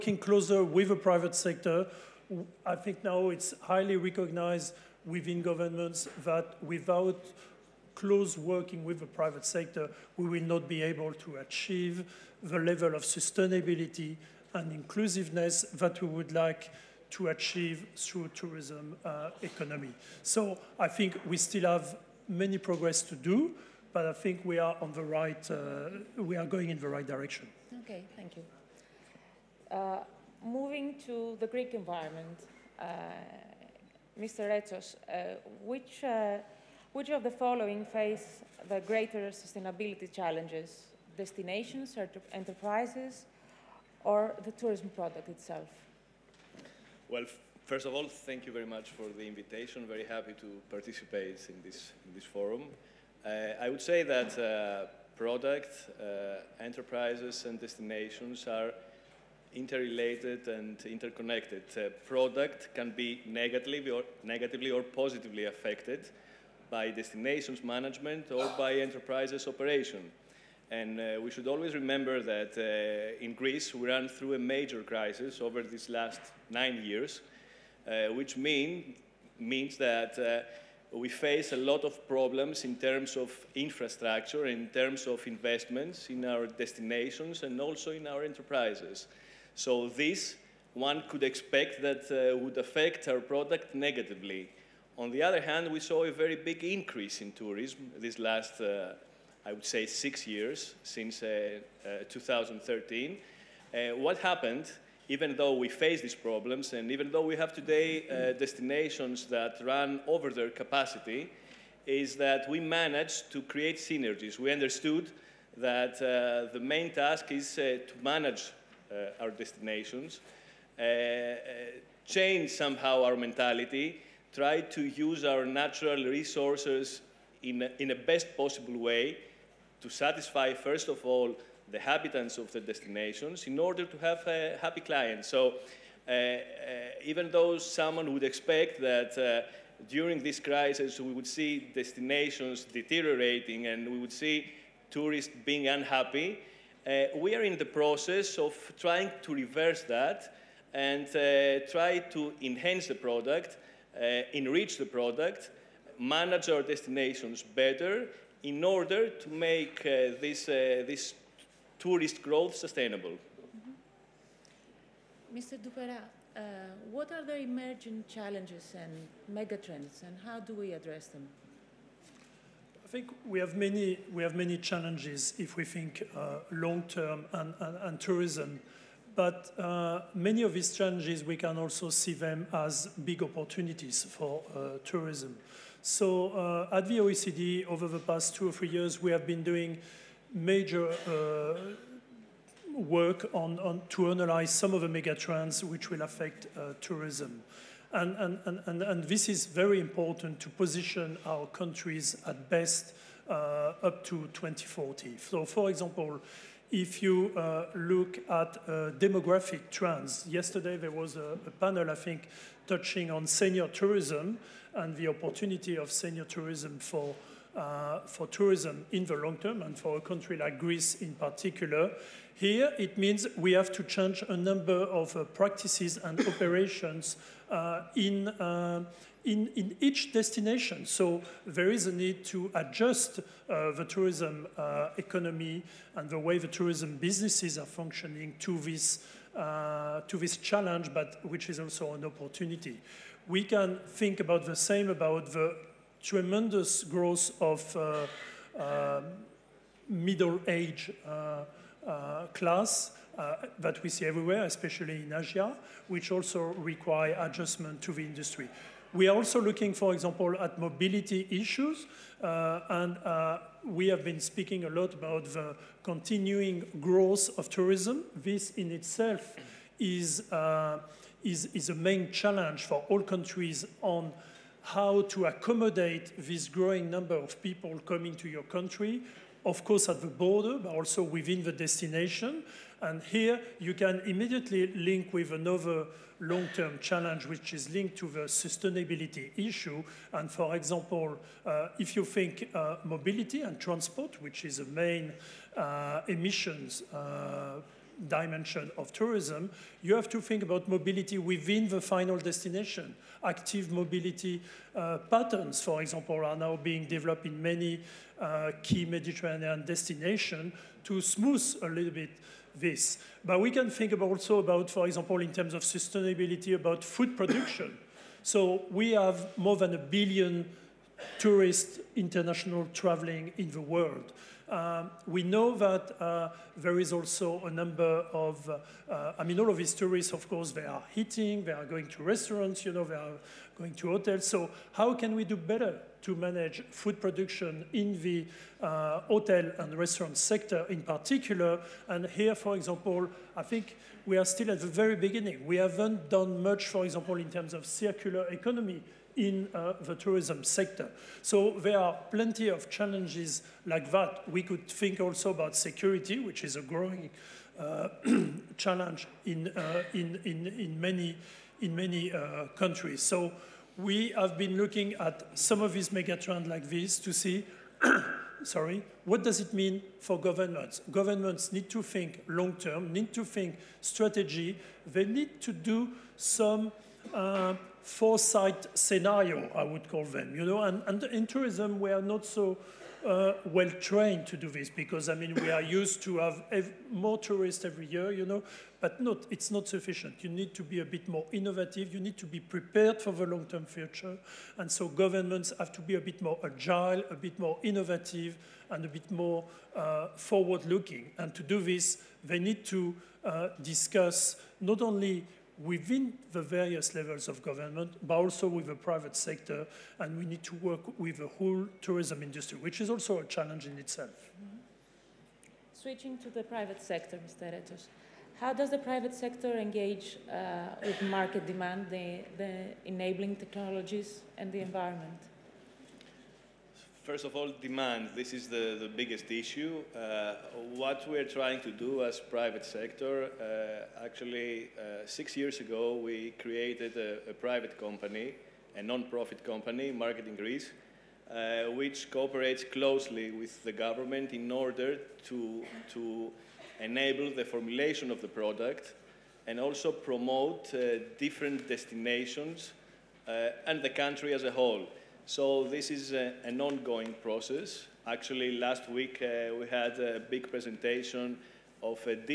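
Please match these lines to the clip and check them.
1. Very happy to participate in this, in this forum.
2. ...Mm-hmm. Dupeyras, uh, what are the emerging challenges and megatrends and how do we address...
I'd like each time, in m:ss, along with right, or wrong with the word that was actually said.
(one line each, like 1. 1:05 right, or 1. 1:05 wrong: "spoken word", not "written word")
1. 0:49 right
2. 2:45 right.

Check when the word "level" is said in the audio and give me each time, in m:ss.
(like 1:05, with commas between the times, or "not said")
0:12, 6:46.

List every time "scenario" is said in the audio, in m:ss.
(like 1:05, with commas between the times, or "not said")
6:18.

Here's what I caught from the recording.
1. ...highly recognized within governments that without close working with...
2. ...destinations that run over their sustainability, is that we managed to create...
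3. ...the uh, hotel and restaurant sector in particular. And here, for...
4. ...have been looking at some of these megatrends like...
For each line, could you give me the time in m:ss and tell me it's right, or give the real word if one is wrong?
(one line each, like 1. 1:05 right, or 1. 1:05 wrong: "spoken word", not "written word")
1. 0:03 right
2. 1:48 wrong: "capacity", not "sustainability"
3. 5:38 right
4. 6:04 right.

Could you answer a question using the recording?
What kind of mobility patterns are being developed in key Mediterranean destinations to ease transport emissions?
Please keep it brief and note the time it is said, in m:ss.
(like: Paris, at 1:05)
Active mobility, at 5:03.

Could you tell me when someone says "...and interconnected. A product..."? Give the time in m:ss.
1:00.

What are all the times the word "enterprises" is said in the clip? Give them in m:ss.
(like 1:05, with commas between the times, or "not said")
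0:42, 0:56, 1:08, 1:28.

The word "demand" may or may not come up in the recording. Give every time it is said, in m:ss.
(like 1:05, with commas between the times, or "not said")
7:01, 7:07.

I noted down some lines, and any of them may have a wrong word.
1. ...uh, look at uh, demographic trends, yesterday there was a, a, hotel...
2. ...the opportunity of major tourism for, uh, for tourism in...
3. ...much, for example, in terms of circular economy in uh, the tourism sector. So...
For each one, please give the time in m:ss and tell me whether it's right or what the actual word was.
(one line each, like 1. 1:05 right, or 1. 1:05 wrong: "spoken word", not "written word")
1. 3:27 wrong: "panel", not "hotel"
2. 3:34 wrong: "senior", not "major"
3. 5:46 right.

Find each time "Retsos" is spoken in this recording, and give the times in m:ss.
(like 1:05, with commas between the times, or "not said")
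0:34, 6:57.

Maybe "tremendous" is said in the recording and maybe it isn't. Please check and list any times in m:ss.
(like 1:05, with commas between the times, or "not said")
4:06.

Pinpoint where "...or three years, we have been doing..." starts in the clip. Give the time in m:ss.
3:08.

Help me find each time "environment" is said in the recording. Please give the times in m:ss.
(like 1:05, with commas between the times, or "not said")
0:31, 7:04.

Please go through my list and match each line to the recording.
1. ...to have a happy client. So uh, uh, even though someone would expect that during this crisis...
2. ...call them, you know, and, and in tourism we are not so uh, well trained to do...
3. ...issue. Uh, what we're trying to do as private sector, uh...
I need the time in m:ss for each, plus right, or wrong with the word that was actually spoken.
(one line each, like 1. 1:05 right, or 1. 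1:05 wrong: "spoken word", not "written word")
1. 2:13 right
2. 6:19 right
3. 7:09 right.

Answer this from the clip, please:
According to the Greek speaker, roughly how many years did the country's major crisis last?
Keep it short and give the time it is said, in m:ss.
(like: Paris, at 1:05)
9 years, at 1:16.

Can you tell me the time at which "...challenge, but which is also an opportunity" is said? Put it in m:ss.
4:00.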